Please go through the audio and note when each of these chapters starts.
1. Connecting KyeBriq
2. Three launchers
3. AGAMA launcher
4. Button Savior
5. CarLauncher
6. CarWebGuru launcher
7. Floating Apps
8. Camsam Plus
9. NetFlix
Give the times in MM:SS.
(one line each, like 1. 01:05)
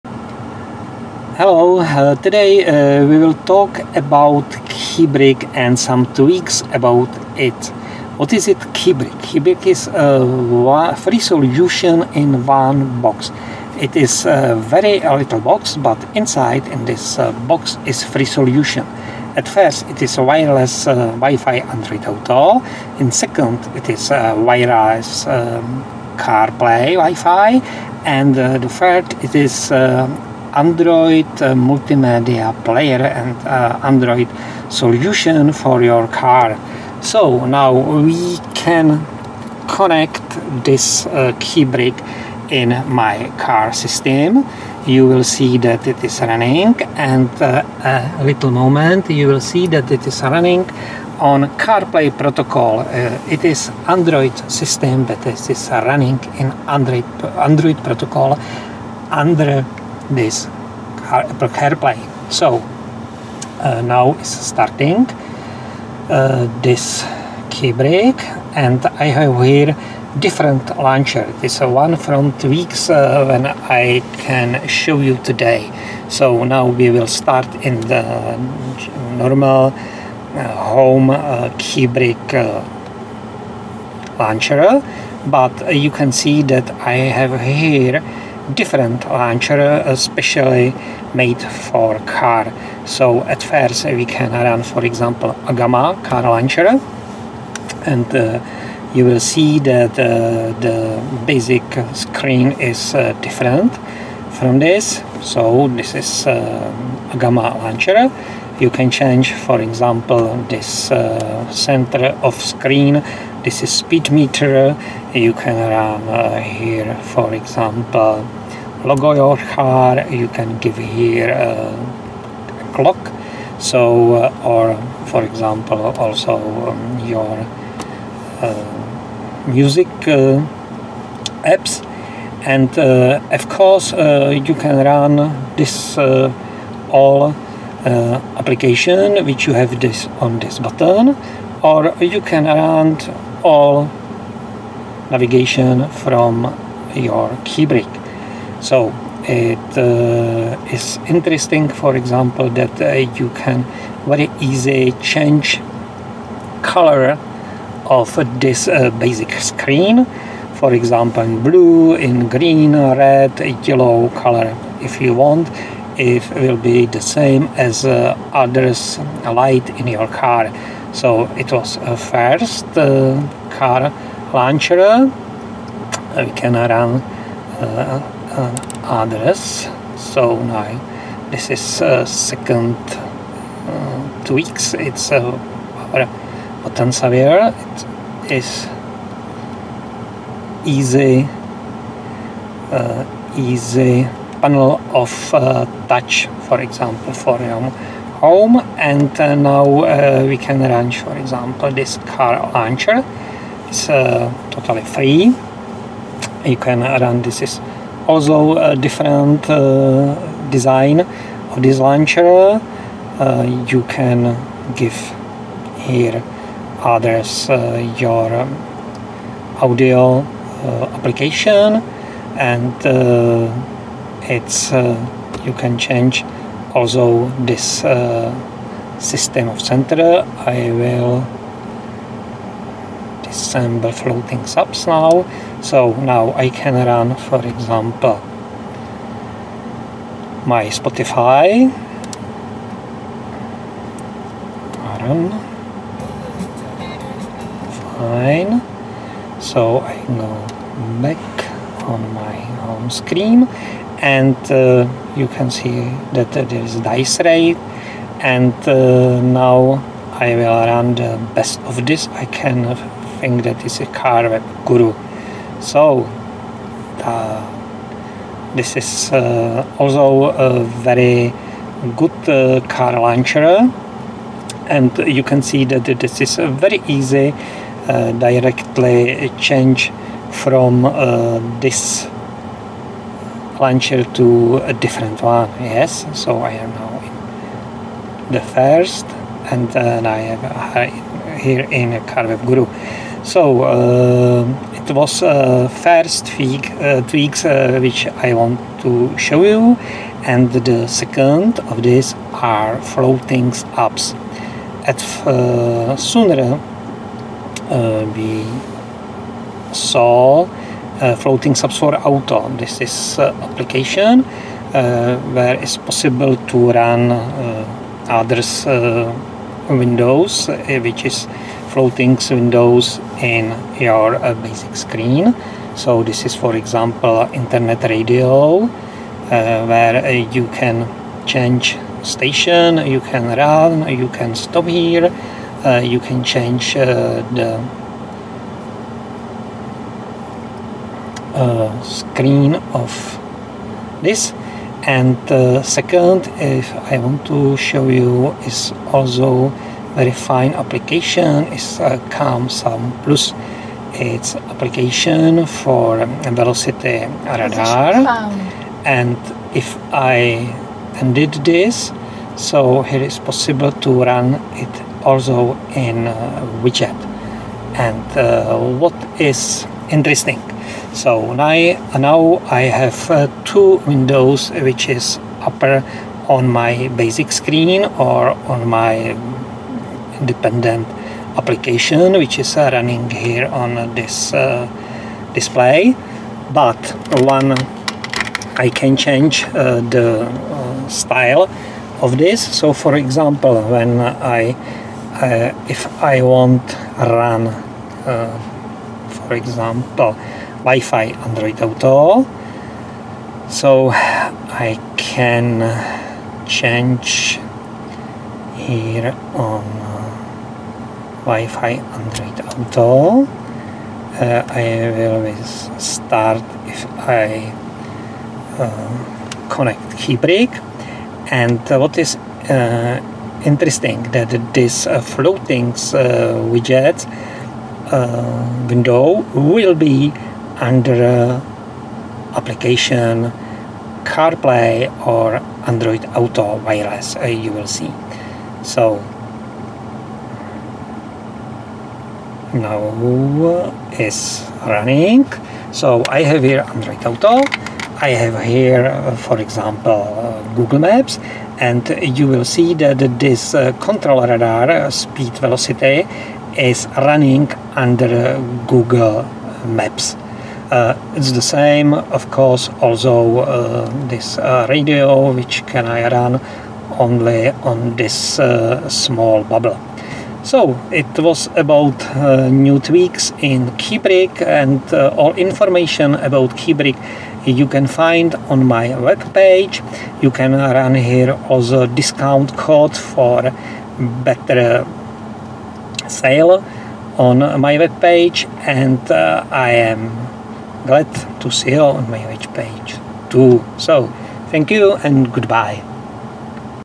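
1. 00:38
2. 01:08
3. 01:35
4. 03:00
5. 03:22
6. 04:23
7. 05:04
8. 05:45
9. 06:26.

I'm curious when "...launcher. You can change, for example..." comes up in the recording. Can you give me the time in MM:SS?
01:47.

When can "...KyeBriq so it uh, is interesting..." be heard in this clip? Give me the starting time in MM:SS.
02:27.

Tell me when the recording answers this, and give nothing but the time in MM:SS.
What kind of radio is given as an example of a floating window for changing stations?
05:27.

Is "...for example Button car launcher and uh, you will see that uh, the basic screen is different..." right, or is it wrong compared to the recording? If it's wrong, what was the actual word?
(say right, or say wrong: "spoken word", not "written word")
wrong: "AGAMA", not "Button".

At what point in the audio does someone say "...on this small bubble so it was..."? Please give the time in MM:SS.
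07:47.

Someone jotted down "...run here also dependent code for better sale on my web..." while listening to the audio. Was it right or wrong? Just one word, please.
wrong.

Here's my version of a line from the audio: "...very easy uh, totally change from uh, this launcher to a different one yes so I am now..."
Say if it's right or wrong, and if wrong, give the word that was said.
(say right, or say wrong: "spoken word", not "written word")
wrong: "directly", not "totally".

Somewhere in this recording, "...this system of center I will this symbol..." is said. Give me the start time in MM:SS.
03:47.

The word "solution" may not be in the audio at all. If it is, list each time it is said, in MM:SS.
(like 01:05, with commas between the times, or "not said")
00:11, 00:18, 00:34.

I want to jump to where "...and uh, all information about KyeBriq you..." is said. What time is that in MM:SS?
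07:54.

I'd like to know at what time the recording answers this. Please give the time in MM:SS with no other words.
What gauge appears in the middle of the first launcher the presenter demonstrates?
01:53.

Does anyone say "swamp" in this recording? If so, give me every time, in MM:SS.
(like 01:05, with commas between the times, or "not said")
not said.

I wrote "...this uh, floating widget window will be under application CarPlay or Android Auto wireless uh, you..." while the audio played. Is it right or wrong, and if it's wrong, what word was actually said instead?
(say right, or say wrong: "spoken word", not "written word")
right.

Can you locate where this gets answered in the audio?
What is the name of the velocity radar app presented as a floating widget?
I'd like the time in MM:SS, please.
05:52.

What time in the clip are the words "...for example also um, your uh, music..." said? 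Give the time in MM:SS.
02:05.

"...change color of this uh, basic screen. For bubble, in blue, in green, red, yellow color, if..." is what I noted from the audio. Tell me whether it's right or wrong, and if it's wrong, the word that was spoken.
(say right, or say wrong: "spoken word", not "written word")
wrong: "example", not "bubble".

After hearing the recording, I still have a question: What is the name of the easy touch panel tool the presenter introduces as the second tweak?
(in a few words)
Button Savior.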